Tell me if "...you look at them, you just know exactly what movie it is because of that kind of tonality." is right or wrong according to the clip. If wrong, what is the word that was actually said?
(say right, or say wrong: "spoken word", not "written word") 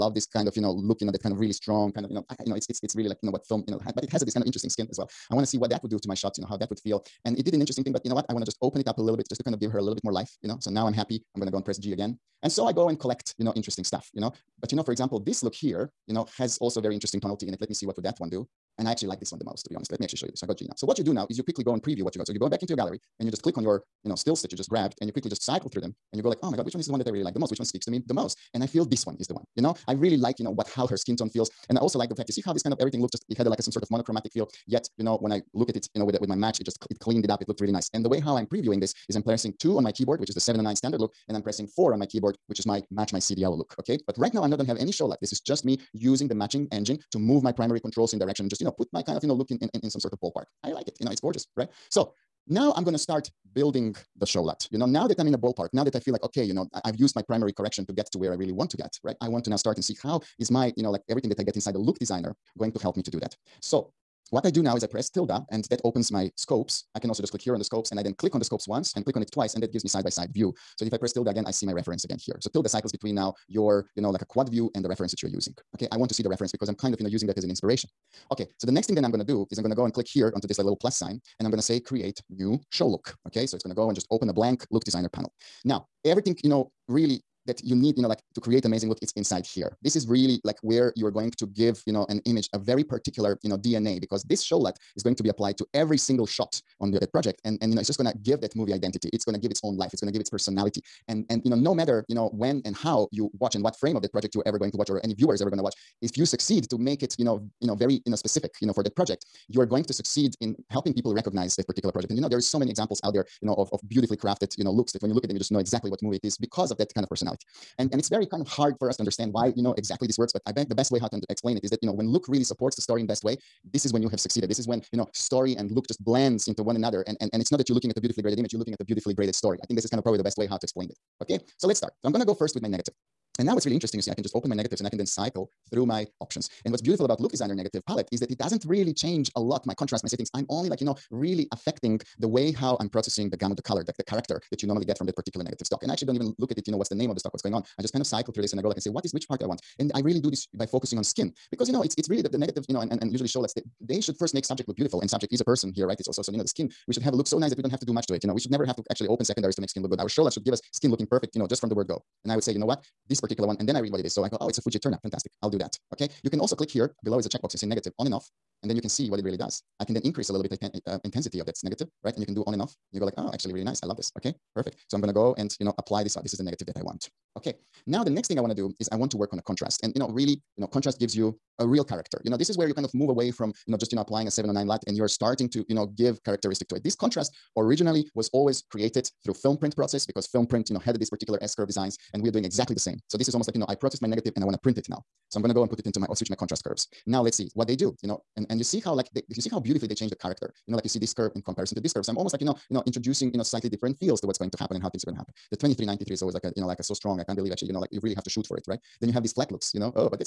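wrong: "personality", not "tonality".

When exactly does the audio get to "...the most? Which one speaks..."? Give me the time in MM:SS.
00:27.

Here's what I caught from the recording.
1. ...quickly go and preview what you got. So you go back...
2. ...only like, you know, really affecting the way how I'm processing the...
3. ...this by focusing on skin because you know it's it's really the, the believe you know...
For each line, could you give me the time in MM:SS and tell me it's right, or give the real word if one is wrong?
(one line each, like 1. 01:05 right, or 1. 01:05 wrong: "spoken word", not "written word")
1. 00:21 right
2. 02:20 right
3. 02:30 wrong: "negative", not "believe".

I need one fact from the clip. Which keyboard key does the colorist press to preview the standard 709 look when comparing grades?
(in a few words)
2.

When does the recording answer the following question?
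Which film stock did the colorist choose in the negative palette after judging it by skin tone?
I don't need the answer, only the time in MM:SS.
02:44.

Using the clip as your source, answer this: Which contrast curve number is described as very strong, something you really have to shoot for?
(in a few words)
2393.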